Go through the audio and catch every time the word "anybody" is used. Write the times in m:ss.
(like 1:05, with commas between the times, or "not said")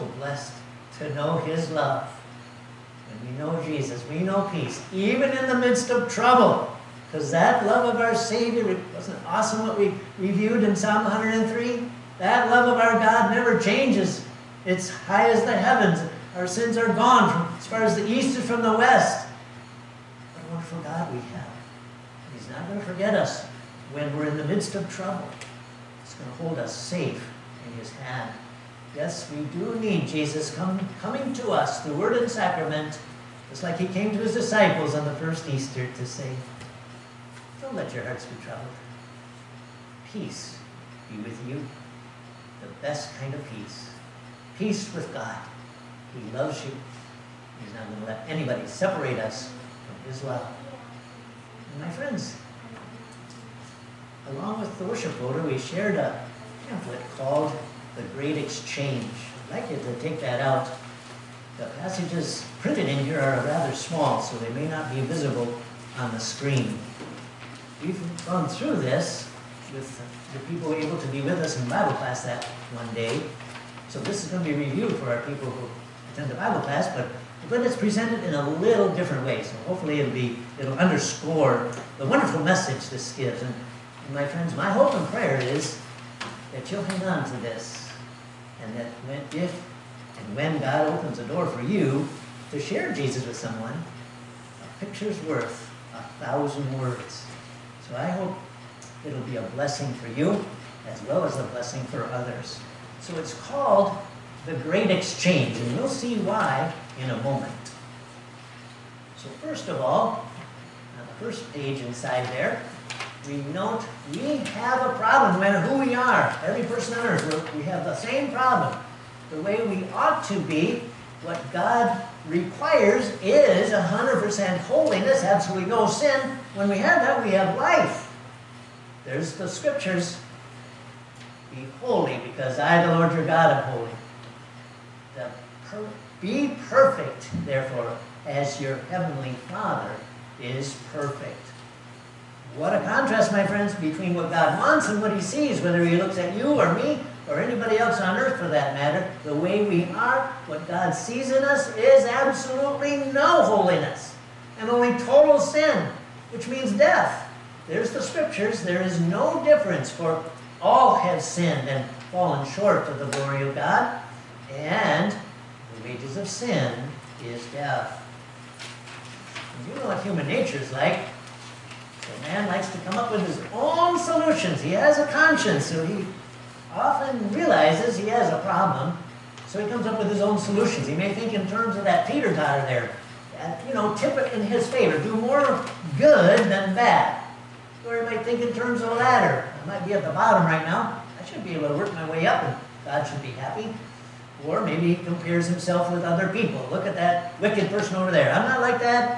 0:48, 2:27.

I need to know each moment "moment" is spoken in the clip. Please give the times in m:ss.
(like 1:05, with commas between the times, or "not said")
1:47.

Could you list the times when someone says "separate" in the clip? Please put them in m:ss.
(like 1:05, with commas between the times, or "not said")
0:48.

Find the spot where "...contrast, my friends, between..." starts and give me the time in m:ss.
2:22.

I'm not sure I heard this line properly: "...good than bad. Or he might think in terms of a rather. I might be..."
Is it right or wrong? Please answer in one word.
wrong.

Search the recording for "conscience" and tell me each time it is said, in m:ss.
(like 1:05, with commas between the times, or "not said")
2:55.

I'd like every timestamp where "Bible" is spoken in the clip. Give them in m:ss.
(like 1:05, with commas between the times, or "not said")
1:11, 1:16.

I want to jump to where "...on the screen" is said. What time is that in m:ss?
1:05.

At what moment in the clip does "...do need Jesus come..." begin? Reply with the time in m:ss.
0:29.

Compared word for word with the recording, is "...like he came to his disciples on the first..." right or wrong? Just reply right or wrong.
right.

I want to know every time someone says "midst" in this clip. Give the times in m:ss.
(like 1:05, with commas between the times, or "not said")
0:05, 0:24.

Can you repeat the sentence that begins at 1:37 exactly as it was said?
So I hope it'll be a blessing for you as well as a blessing for others.